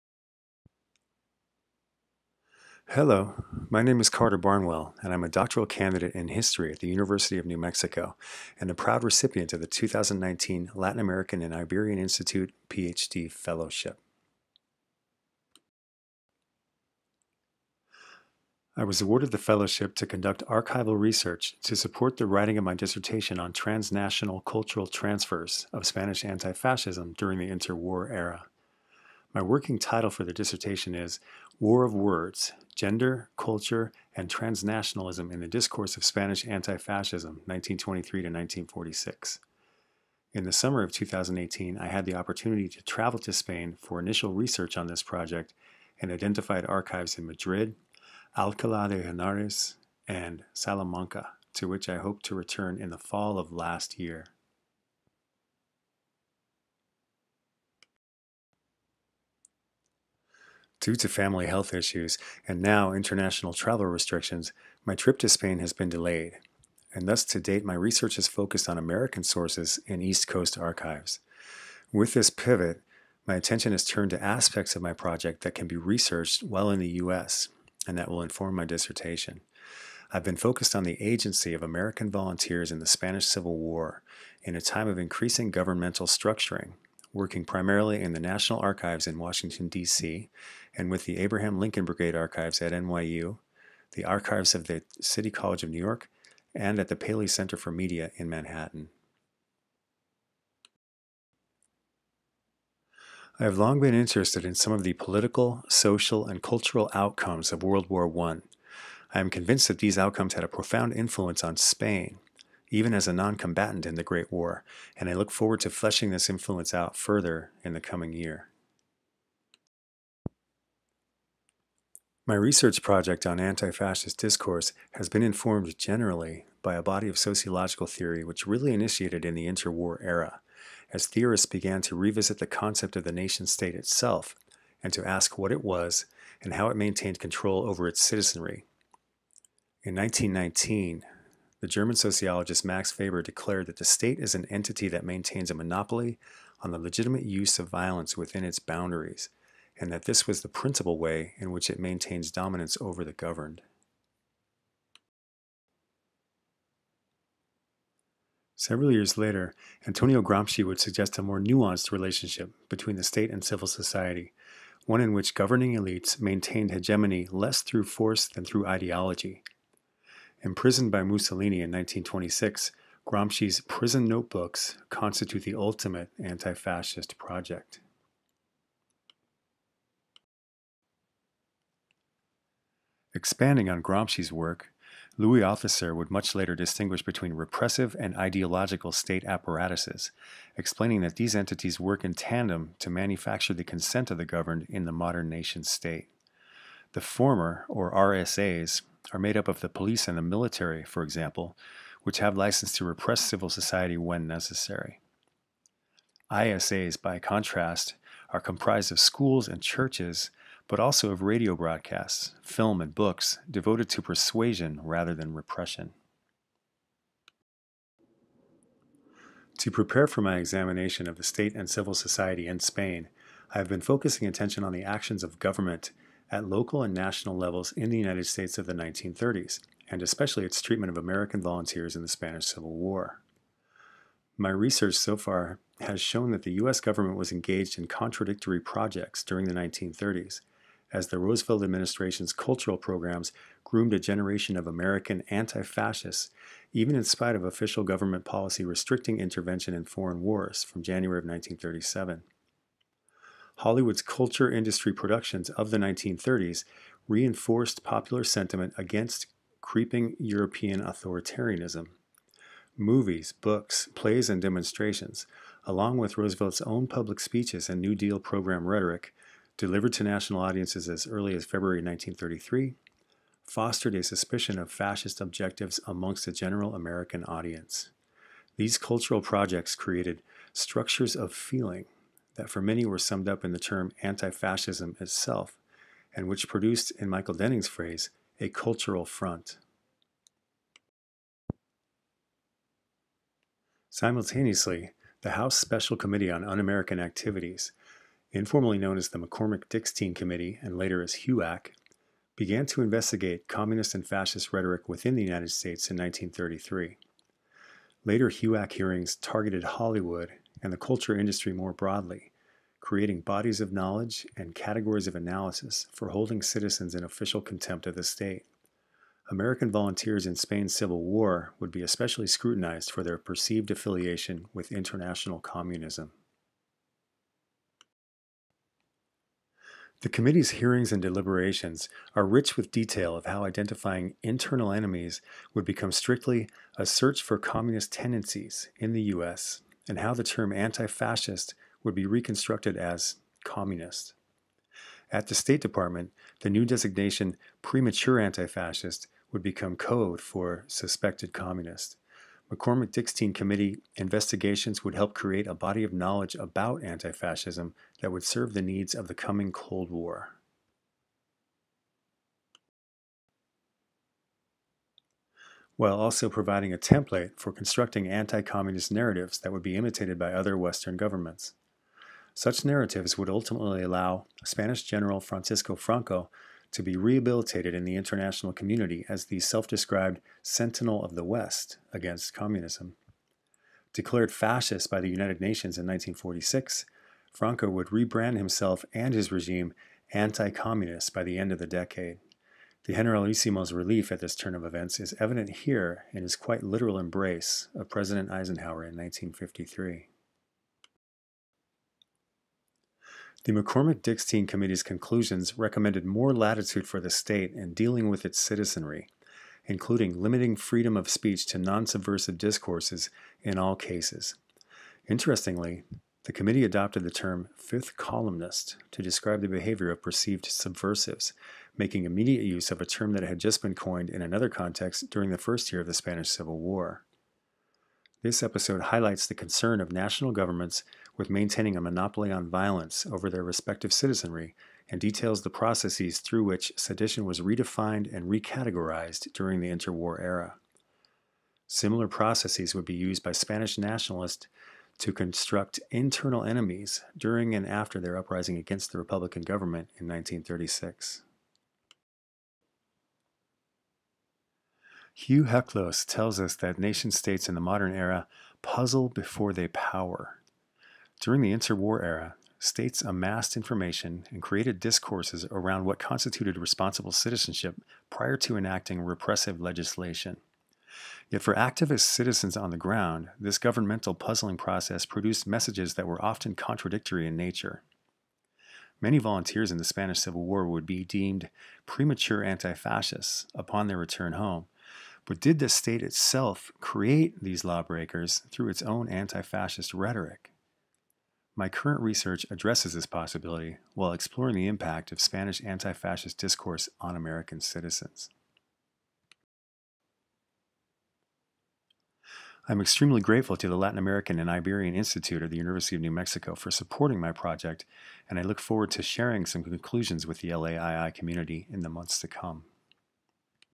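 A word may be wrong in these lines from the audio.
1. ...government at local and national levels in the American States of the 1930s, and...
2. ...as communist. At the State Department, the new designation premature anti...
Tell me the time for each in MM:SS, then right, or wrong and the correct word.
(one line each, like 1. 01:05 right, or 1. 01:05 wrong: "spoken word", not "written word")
1. 03:45 wrong: "United", not "American"
2. 05:42 right.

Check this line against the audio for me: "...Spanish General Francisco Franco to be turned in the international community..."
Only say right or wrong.
wrong.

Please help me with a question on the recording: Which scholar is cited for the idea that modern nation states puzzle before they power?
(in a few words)
Hugh Heclo.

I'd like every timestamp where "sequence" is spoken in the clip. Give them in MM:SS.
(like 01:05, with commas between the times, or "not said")
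not said.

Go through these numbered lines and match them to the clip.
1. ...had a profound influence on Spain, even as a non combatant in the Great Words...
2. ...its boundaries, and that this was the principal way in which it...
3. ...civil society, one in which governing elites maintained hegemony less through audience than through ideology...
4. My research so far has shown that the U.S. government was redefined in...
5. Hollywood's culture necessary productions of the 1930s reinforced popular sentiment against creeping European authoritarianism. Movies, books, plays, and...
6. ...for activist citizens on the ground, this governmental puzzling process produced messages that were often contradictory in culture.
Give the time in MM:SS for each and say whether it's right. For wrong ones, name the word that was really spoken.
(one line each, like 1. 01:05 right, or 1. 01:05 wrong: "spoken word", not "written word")
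1. 01:50 wrong: "War", not "Words"
2. 02:28 right
3. 02:43 wrong: "force", not "audience"
4. 03:54 wrong: "engaged", not "redefined"
5. 04:13 wrong: "industry", not "necessary"
6. 07:51 wrong: "nature", not "culture".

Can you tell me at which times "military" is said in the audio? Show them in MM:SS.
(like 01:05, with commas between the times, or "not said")
03:20.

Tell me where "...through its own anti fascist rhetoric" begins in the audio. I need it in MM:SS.
08:08.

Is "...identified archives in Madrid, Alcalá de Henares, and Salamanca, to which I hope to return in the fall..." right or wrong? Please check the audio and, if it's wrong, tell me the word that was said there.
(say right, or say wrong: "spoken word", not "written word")
right.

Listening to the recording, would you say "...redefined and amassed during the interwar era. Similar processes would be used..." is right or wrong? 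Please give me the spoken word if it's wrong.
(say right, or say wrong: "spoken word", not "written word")
wrong: "recategorized", not "amassed".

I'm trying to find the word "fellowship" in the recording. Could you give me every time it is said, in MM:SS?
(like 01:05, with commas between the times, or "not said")
00:13, 00:19.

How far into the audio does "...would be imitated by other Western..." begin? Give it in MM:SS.
06:09.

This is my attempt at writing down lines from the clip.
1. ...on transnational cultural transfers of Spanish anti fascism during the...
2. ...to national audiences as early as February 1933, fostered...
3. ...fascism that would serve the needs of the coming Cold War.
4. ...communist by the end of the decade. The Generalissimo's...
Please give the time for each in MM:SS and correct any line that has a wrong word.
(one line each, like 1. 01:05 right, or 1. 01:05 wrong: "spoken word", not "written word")
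1. 00:23 right
2. 04:29 right
3. 05:57 right
4. 06:30 right.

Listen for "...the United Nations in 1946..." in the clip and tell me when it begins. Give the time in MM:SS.
06:25.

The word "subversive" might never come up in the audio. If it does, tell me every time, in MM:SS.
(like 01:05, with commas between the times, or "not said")
06:51, 07:00.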